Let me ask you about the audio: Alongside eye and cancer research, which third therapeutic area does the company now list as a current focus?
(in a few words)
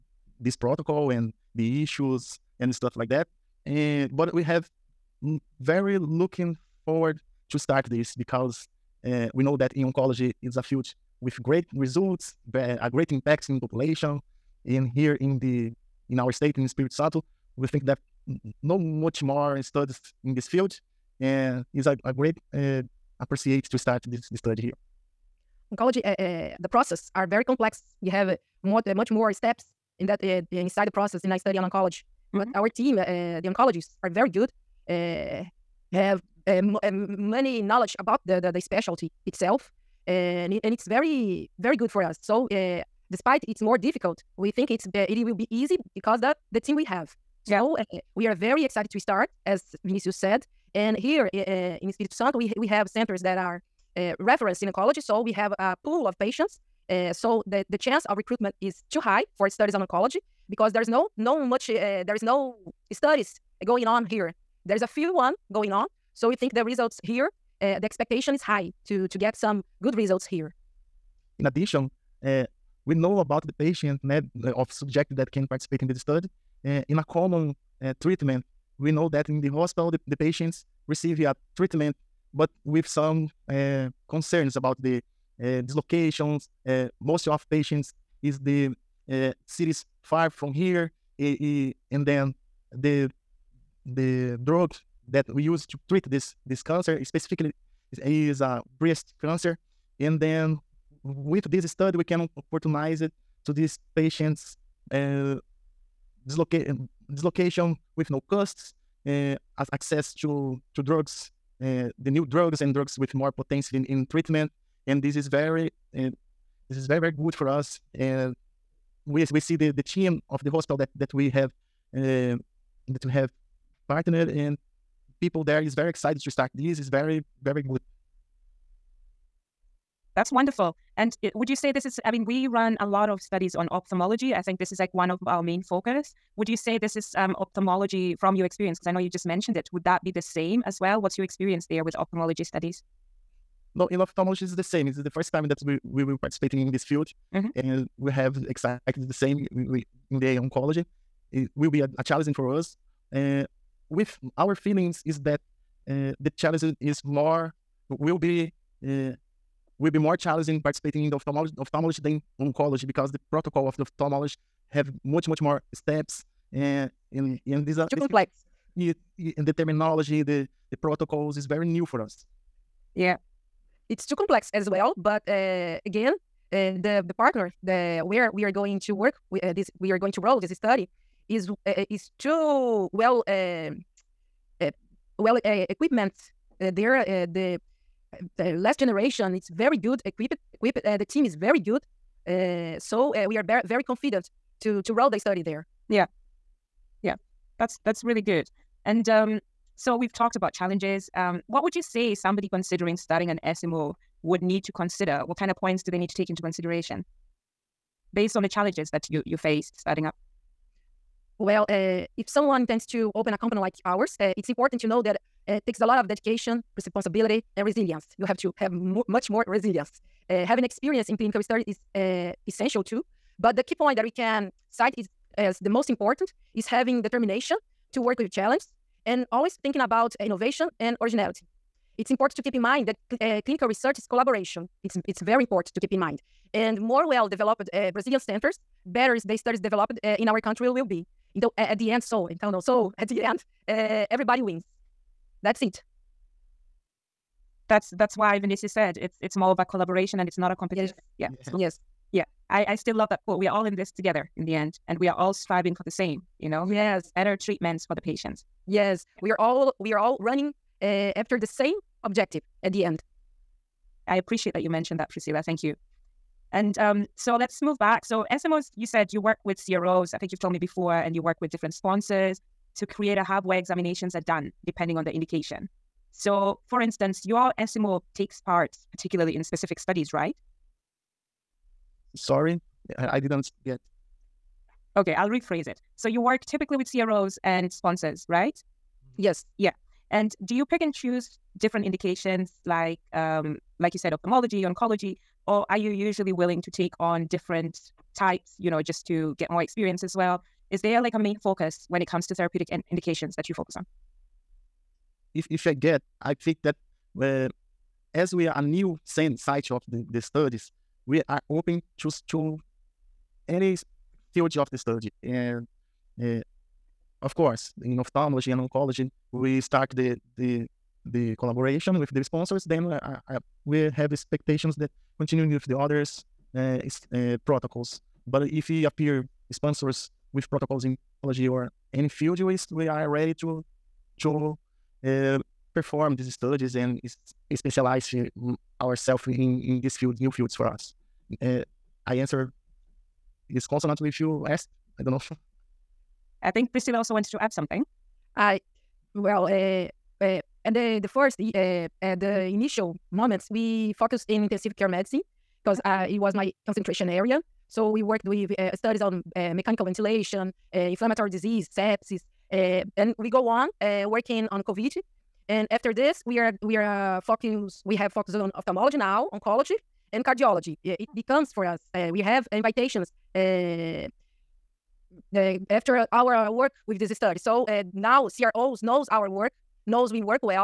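Cardiology.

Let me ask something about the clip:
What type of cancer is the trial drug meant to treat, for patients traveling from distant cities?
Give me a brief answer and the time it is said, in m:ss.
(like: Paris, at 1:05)
Breast cancer, at 1:38.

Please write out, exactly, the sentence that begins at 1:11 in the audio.
In addition, uh, we know about the patient né, eh, of subject that can participate in this study.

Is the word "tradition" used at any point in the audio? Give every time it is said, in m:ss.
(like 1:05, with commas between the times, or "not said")
not said.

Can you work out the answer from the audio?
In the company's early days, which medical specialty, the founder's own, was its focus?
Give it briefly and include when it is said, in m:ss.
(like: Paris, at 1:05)
Intensive care medicine, at 5:54.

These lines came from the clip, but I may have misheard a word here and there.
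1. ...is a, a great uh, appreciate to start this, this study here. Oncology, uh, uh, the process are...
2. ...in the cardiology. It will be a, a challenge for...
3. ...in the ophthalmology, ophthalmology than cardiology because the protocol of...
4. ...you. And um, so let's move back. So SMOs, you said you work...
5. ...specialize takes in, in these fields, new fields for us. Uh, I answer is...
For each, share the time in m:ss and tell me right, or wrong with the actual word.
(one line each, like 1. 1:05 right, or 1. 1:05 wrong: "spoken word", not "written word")
1. 0:21 right
2. 2:29 wrong: "oncology", not "cardiology"
3. 2:41 wrong: "oncology", not "cardiology"
4. 4:25 right
5. 5:37 wrong: "ourselves", not "takes".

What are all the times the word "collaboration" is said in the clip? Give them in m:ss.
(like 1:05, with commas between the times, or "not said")
3:54, 4:09, 5:21.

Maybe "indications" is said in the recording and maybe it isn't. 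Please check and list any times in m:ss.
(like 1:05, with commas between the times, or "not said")
4:35, 4:51, 5:02.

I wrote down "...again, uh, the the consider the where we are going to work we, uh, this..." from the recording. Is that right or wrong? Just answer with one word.
wrong.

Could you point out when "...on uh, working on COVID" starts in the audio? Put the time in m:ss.
6:03.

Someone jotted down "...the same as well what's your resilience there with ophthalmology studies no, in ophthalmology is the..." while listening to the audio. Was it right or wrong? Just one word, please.
wrong.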